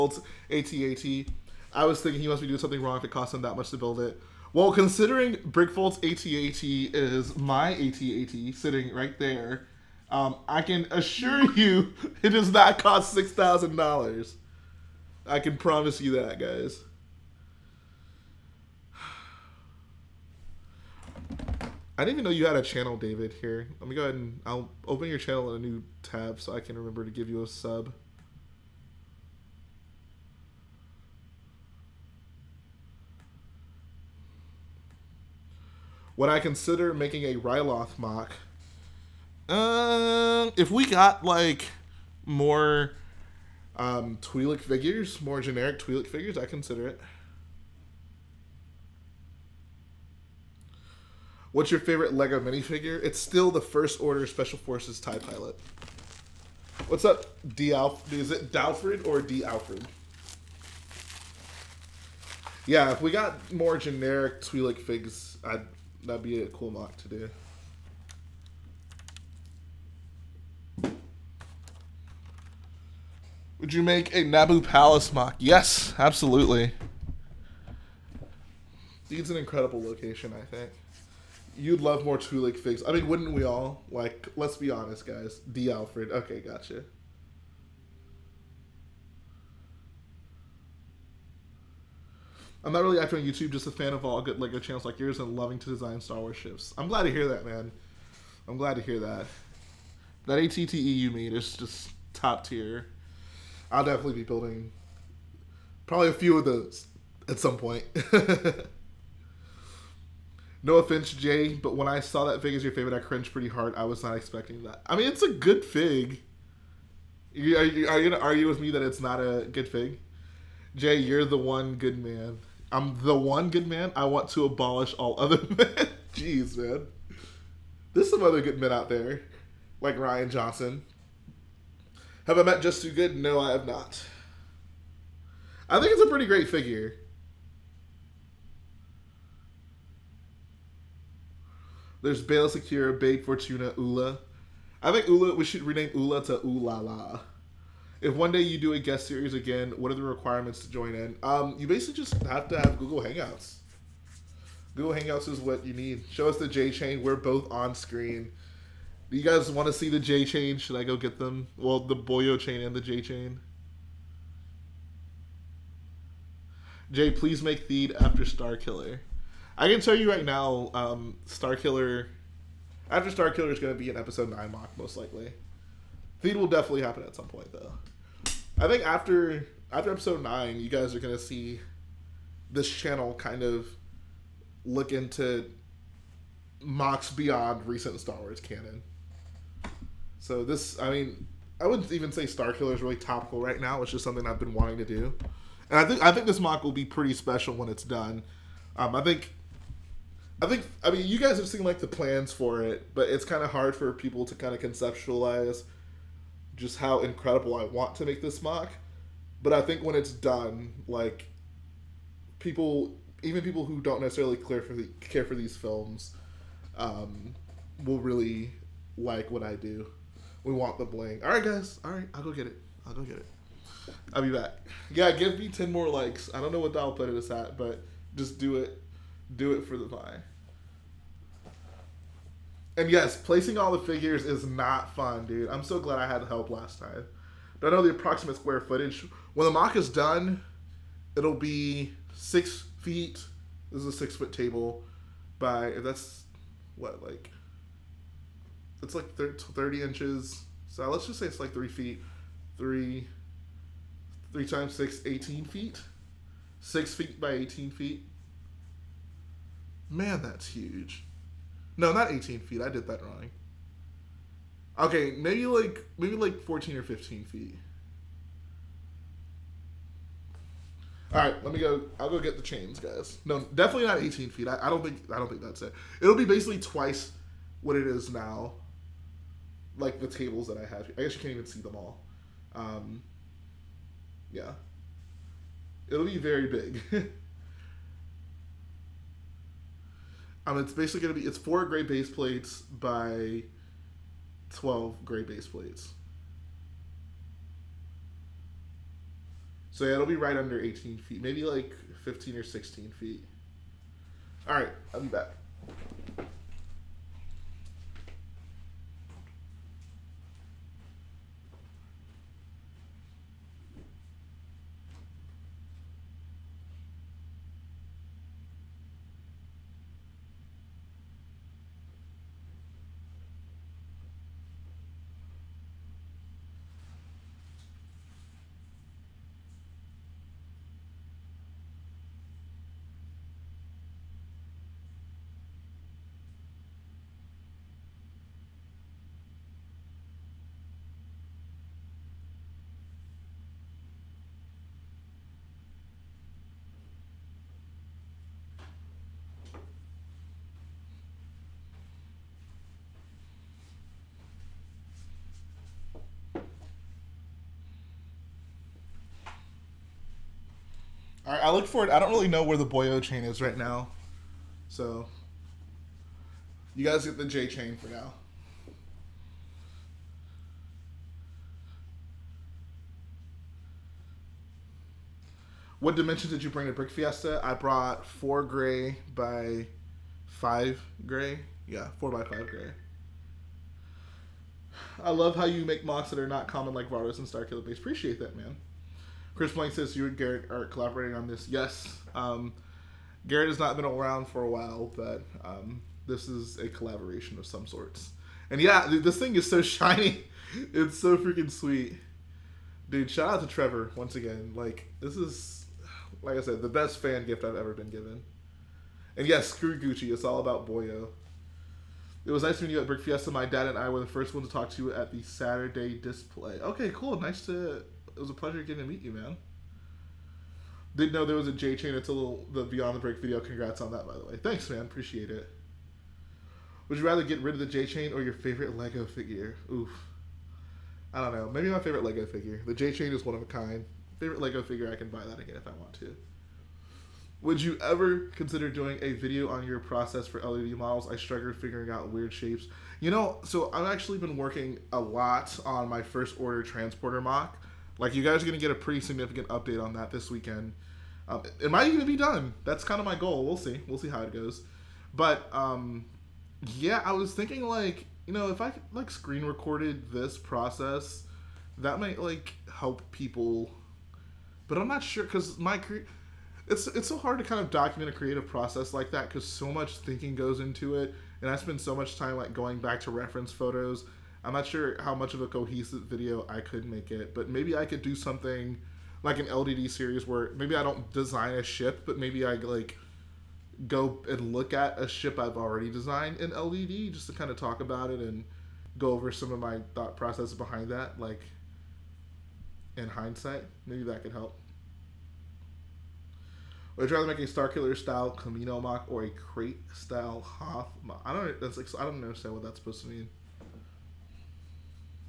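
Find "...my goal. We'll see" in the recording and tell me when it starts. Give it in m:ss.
7:33.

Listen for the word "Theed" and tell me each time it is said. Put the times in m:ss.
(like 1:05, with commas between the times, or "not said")
2:47, 2:56.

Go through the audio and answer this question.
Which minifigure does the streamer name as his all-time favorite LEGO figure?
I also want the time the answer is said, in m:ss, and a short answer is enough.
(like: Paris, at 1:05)
First Order Special Forces TIE Pilot, at 0:53.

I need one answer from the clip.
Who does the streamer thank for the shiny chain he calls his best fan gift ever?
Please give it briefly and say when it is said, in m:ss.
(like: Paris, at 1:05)
Trevor, at 6:43.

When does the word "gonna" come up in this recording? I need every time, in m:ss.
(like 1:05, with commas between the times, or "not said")
1:58, 7:28.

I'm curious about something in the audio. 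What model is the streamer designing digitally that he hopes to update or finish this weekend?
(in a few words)
First Order transporter.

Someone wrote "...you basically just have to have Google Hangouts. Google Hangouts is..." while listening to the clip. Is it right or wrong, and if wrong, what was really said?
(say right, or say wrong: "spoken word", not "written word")
right.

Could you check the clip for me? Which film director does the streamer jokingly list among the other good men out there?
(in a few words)
Rian Johnson.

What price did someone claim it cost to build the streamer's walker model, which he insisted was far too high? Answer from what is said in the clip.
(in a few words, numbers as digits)
$6,000.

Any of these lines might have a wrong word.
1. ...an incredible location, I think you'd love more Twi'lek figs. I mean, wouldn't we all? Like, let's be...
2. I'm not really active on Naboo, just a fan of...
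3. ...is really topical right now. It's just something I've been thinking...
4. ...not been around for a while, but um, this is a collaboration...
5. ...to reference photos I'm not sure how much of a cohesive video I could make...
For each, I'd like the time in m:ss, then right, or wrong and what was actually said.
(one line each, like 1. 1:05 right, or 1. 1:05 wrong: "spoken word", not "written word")
1. 1:19 right
2. 1:32 wrong: "YouTube", not "Naboo"
3. 3:12 wrong: "wanting", not "thinking"
4. 6:33 right
5. 7:53 right.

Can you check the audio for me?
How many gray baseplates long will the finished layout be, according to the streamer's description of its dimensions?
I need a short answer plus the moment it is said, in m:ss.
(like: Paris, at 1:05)
12, at 4:54.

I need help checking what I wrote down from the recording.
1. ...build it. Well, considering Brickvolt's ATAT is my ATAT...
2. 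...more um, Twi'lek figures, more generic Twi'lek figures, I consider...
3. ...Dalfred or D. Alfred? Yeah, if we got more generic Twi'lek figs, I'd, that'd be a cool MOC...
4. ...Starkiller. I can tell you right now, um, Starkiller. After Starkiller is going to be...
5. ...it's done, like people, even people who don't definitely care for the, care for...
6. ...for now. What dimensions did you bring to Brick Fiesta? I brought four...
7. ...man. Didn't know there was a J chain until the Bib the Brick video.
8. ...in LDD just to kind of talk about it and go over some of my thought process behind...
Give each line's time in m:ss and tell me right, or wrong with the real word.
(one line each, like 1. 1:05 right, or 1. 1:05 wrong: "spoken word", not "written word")
1. 0:03 right
2. 0:42 right
3. 0:58 right
4. 2:48 right
5. 3:29 wrong: "necessarily", not "definitely"
6. 6:07 right
7. 6:59 wrong: "Beyond", not "Bib"
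8. 8:06 right.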